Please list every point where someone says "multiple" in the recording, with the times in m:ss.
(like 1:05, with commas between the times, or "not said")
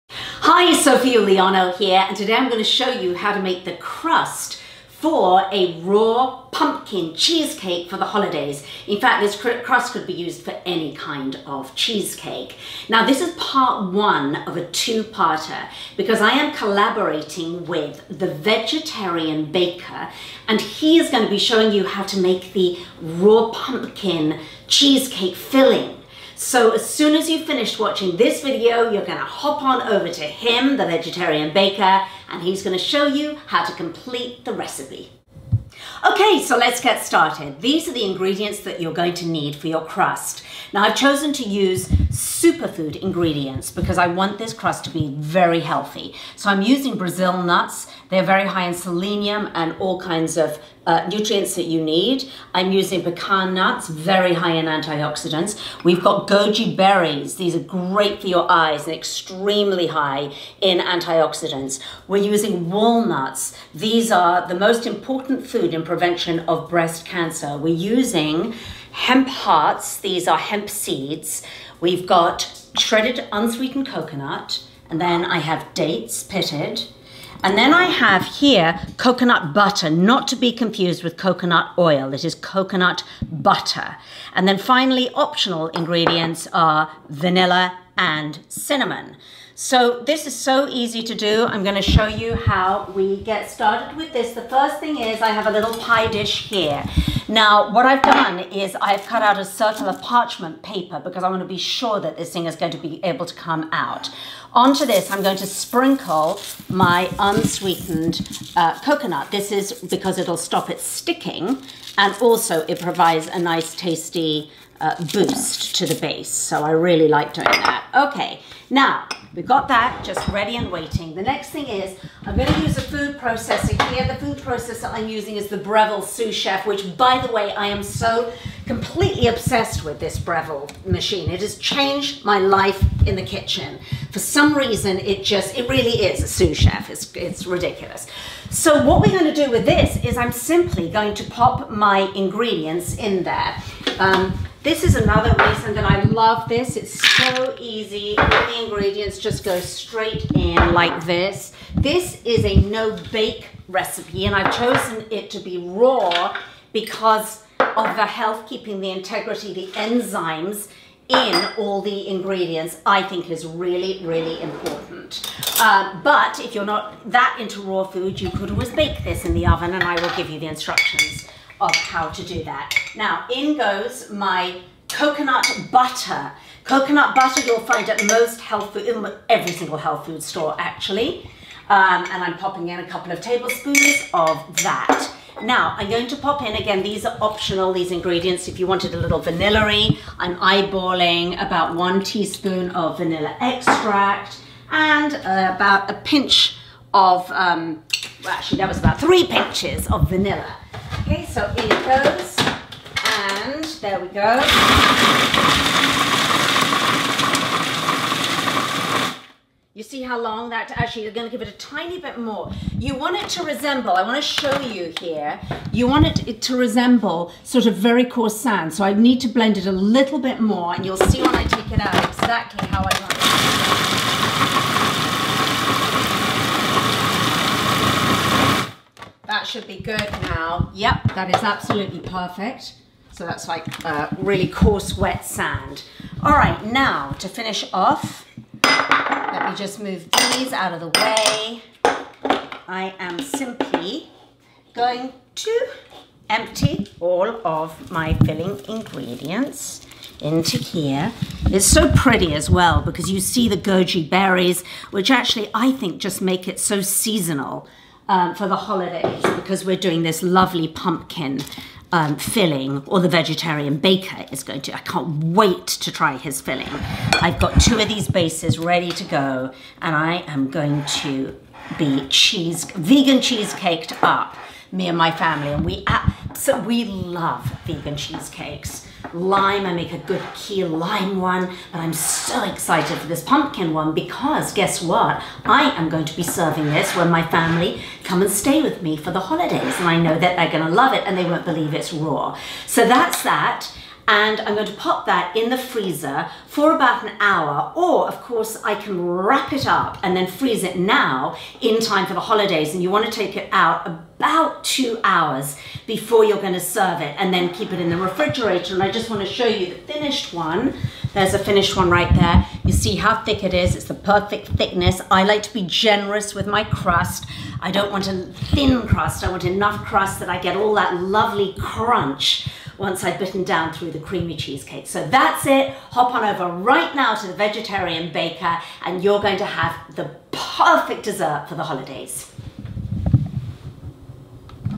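not said.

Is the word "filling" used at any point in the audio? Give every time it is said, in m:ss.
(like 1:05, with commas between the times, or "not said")
0:25, 4:08, 4:22, 4:26.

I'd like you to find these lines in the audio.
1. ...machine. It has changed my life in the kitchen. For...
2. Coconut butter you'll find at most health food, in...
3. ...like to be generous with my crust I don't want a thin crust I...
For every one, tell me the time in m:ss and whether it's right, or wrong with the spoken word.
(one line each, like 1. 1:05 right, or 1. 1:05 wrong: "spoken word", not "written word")
1. 2:10 right
2. 2:56 right
3. 5:15 right.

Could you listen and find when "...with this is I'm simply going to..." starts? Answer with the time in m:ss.
2:19.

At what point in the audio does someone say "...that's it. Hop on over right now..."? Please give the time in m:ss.
5:25.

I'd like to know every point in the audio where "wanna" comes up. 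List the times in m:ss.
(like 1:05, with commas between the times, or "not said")
1:41, 3:34.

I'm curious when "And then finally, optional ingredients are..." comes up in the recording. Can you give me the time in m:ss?
1:24.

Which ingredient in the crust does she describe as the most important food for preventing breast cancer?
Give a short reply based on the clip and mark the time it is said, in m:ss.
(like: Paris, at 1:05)
Walnuts, at 1:02.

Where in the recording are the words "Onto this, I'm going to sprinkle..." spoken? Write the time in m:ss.
1:44.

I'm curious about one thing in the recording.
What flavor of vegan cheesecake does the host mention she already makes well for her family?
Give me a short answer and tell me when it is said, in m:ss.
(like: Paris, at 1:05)
Key lime, at 4:40.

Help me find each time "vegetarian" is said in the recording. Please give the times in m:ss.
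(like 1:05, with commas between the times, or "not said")
0:18, 0:30, 4:23, 5:27.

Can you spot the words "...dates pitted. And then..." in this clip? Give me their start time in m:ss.
1:15.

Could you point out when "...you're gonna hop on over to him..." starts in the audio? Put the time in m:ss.
0:28.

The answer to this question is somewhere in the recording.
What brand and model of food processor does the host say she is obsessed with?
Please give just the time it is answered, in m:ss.
2:05.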